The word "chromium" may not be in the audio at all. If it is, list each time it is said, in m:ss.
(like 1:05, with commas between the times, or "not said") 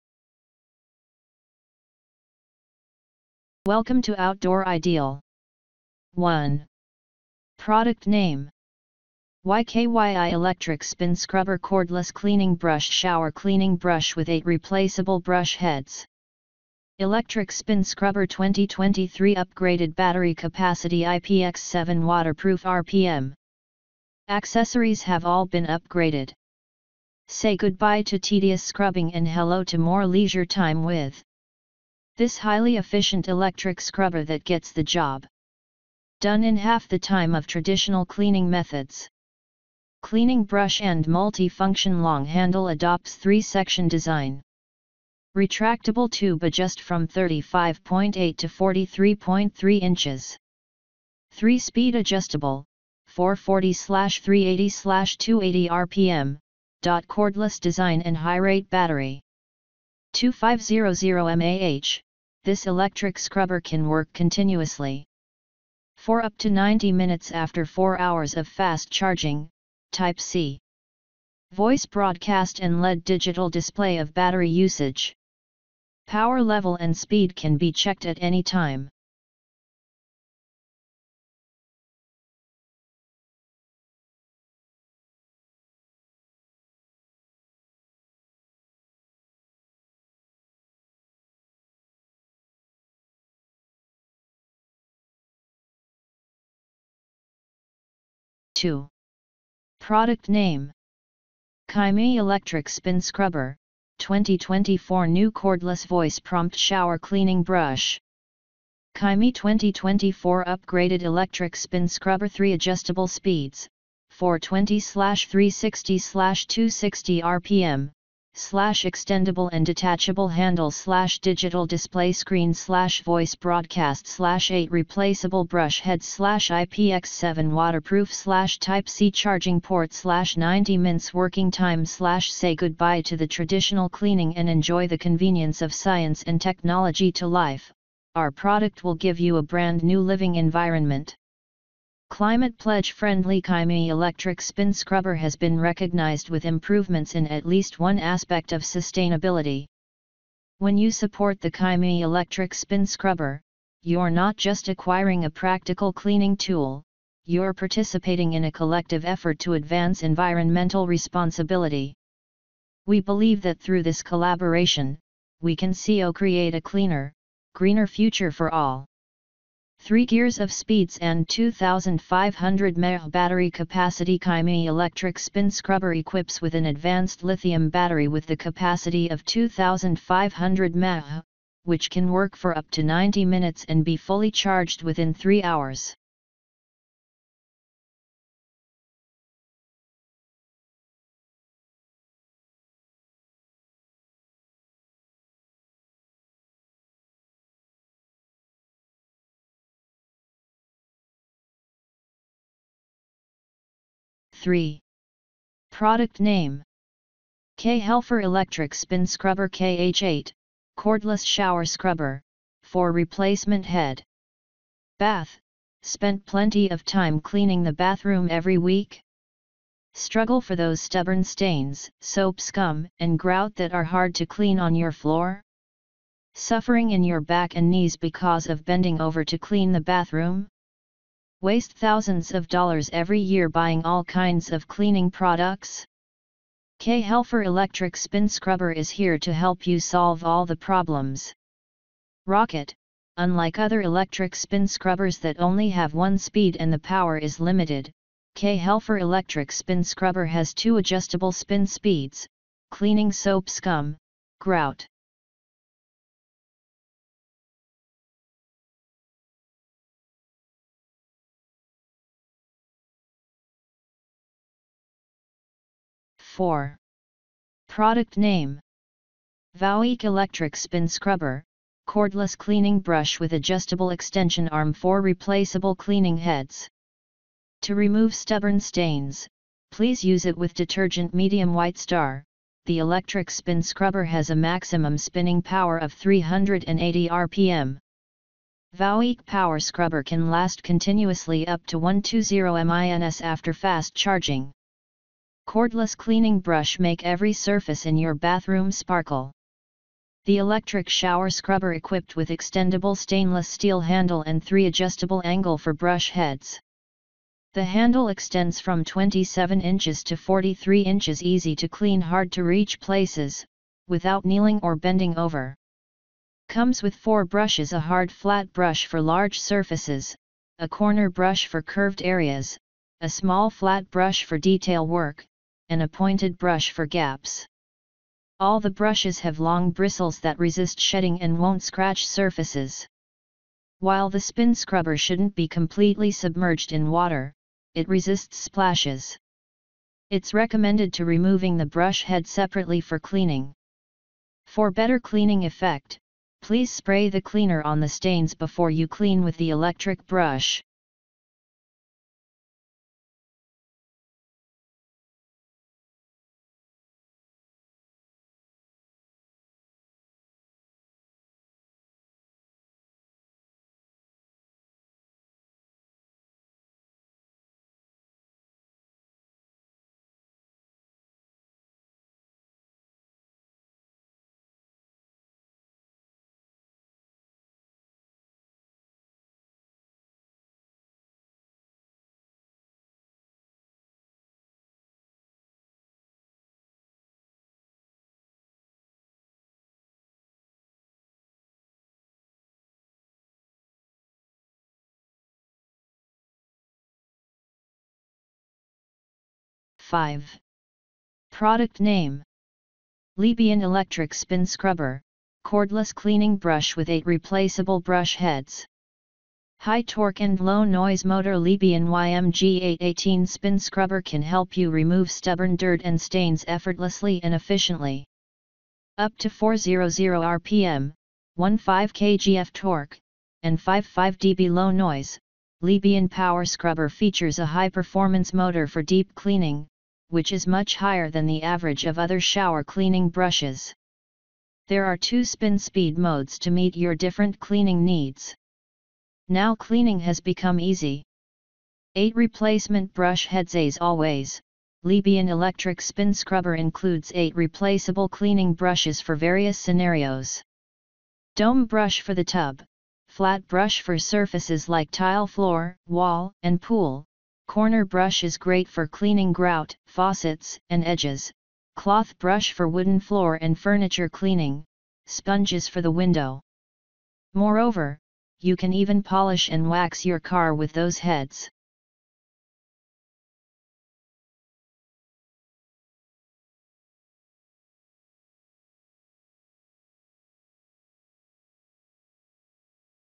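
not said.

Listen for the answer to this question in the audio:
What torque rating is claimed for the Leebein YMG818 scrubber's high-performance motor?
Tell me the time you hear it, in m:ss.
7:01.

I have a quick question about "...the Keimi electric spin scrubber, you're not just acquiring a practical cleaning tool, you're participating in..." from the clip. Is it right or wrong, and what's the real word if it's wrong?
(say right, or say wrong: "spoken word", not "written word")
right.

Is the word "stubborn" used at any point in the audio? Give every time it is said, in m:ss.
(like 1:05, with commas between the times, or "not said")
3:40, 4:38, 6:55.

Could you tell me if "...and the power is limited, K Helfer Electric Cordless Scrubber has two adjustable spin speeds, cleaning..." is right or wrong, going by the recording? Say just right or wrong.
wrong.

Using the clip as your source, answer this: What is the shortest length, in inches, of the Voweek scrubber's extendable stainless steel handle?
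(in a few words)
27 inches.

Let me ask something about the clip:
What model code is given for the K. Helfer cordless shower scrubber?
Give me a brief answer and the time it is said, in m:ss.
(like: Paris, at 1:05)
KH8, at 3:29.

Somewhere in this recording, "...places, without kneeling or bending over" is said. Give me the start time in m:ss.
5:12.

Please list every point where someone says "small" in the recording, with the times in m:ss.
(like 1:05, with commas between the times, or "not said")
5:23.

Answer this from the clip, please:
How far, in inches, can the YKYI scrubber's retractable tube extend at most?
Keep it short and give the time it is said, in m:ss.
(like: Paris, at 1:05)
43.3 inches, at 0:48.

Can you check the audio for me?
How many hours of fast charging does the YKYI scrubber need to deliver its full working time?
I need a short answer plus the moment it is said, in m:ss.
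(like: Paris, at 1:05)
4 hours, at 1:07.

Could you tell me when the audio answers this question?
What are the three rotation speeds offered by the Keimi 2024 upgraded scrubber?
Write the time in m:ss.
1:54.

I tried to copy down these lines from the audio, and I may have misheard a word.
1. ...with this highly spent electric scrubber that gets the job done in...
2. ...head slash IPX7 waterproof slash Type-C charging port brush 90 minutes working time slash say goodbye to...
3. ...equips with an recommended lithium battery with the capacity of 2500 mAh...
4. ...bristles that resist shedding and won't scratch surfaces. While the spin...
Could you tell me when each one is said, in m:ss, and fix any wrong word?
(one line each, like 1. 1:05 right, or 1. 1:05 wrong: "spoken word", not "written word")
1. 0:30 wrong: "efficient", not "spent"
2. 2:05 wrong: "slash", not "brush"
3. 2:55 wrong: "advanced", not "recommended"
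4. 5:29 right.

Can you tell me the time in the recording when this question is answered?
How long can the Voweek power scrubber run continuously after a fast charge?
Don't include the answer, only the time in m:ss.
4:51.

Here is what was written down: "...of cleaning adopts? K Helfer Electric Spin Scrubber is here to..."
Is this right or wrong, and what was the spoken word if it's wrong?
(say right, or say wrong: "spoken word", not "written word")
wrong: "products", not "adopts".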